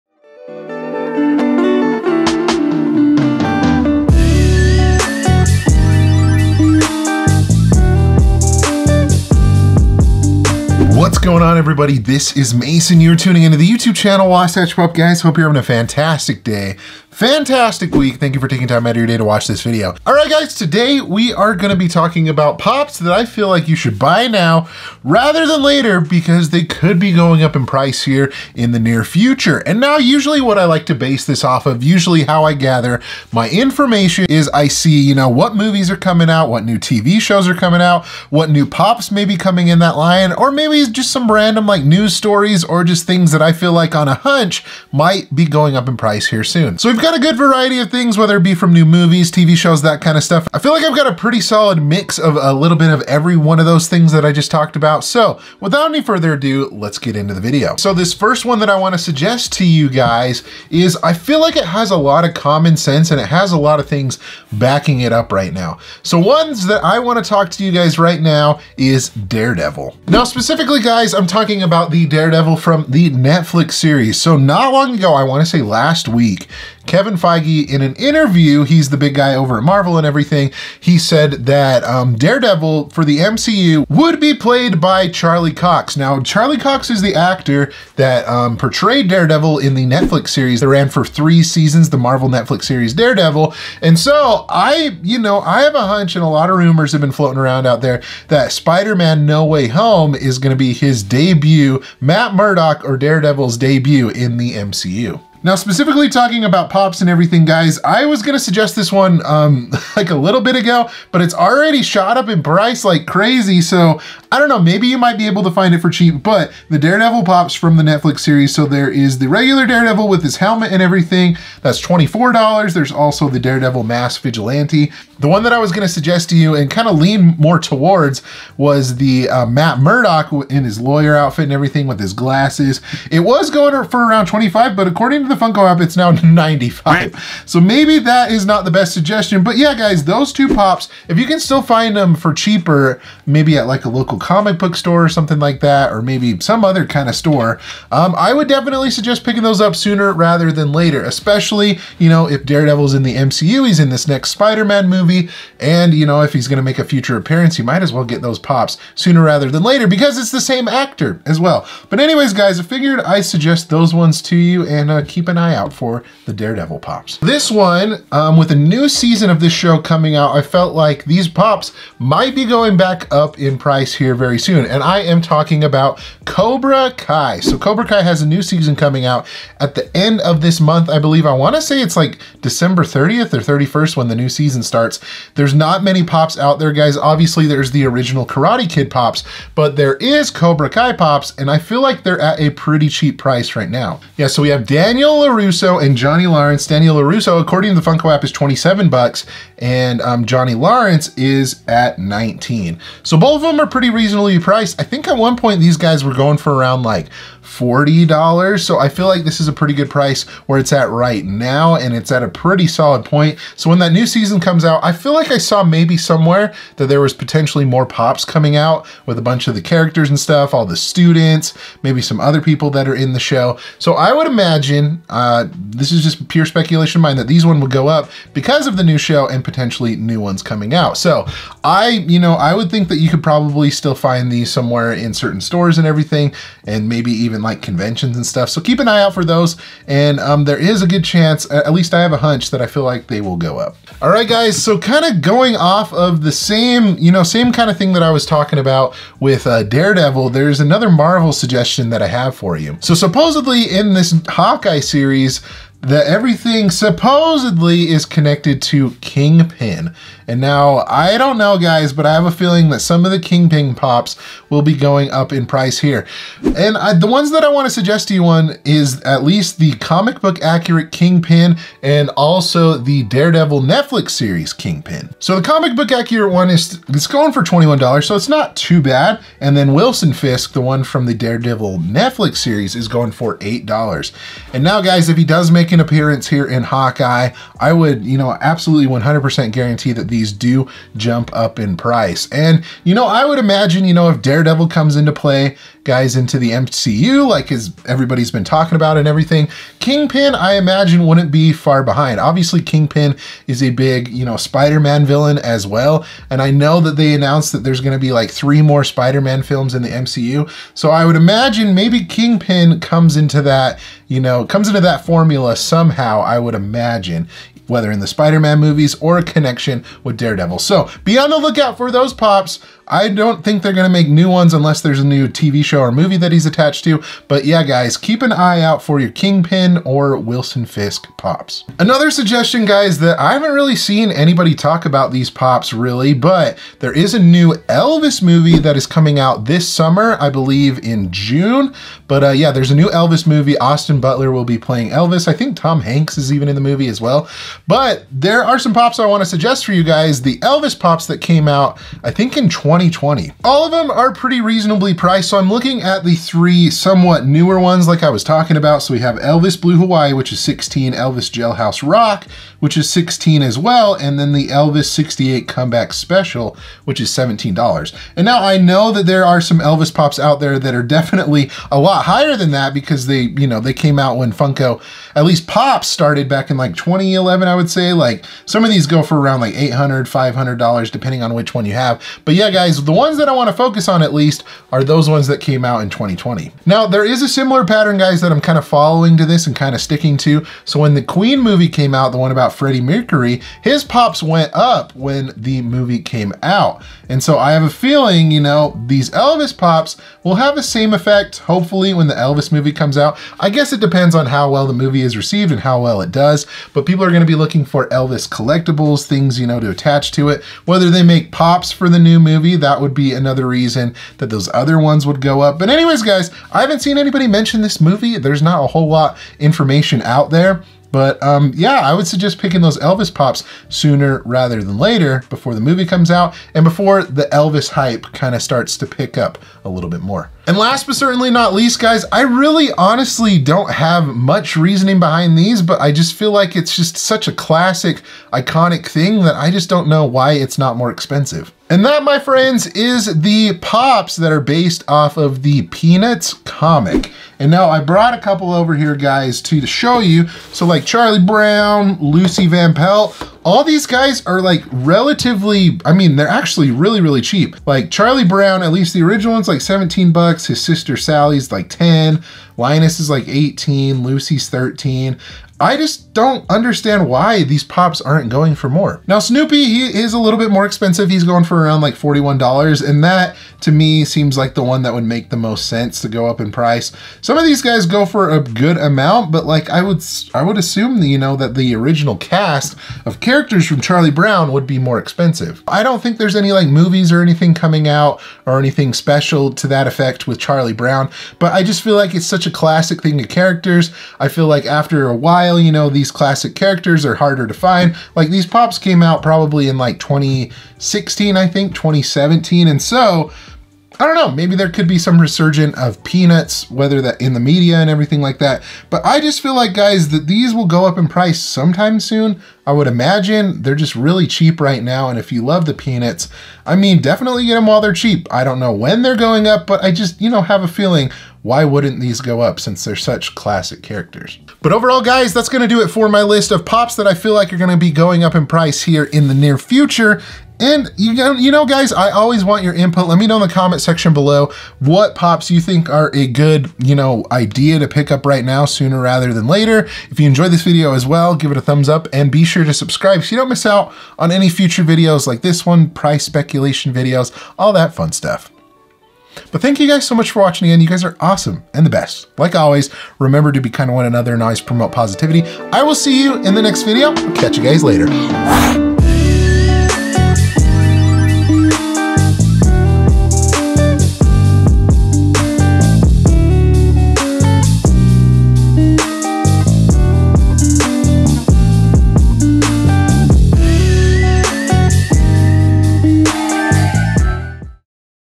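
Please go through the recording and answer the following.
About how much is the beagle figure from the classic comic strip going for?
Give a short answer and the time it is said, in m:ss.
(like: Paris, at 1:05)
$41, at 7:51.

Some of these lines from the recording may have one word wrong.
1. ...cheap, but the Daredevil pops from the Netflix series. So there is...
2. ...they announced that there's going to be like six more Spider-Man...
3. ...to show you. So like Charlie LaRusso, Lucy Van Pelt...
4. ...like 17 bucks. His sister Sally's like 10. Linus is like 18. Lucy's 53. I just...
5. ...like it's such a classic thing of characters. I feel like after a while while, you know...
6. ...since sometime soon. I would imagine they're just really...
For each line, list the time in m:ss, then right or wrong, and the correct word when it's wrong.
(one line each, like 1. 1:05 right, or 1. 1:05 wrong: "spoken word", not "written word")
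1. 1:55 right
2. 5:06 wrong: "three", not "six"
3. 7:29 wrong: "Brown", not "LaRusso"
4. 7:39 wrong: "13", not "53"
5. 8:11 right
6. 8:31 wrong: "price", not "since".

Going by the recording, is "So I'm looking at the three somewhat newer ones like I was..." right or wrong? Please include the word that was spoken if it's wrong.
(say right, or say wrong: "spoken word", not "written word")
right.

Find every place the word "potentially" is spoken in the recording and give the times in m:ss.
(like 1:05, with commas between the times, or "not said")
3:37, 3:49.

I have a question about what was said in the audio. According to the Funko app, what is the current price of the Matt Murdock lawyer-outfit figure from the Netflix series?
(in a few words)
$95.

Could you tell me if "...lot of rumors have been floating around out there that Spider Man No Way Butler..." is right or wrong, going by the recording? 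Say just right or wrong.
wrong.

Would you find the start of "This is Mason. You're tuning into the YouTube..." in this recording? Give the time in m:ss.
0:11.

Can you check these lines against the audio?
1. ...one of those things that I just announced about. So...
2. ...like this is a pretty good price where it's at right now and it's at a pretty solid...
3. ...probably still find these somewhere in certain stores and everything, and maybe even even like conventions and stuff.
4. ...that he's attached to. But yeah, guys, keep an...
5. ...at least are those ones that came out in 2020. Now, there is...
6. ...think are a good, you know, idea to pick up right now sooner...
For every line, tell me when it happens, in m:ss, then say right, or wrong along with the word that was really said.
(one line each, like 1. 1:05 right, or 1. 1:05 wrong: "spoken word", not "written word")
1. 0:53 wrong: "talked", not "announced"
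2. 3:29 right
3. 3:53 right
4. 5:26 right
5. 6:24 right
6. 8:55 right.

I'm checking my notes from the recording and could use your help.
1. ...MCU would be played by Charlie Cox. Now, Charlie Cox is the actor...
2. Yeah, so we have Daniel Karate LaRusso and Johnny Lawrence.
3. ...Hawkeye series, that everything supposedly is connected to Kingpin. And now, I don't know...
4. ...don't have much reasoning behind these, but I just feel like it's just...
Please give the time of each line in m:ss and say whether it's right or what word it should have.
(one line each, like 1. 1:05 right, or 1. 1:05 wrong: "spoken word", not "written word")
1. 1:23 right
2. 3:14 wrong: "Daniel", not "Karate"
3. 4:14 right
4. 7:13 right.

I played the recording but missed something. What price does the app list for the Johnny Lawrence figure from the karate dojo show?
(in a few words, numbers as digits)
$19.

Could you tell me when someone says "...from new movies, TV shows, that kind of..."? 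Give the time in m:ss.
0:48.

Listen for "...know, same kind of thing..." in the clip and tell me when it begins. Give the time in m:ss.
4:07.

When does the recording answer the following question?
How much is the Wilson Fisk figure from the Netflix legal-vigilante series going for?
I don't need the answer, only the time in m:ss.
4:43.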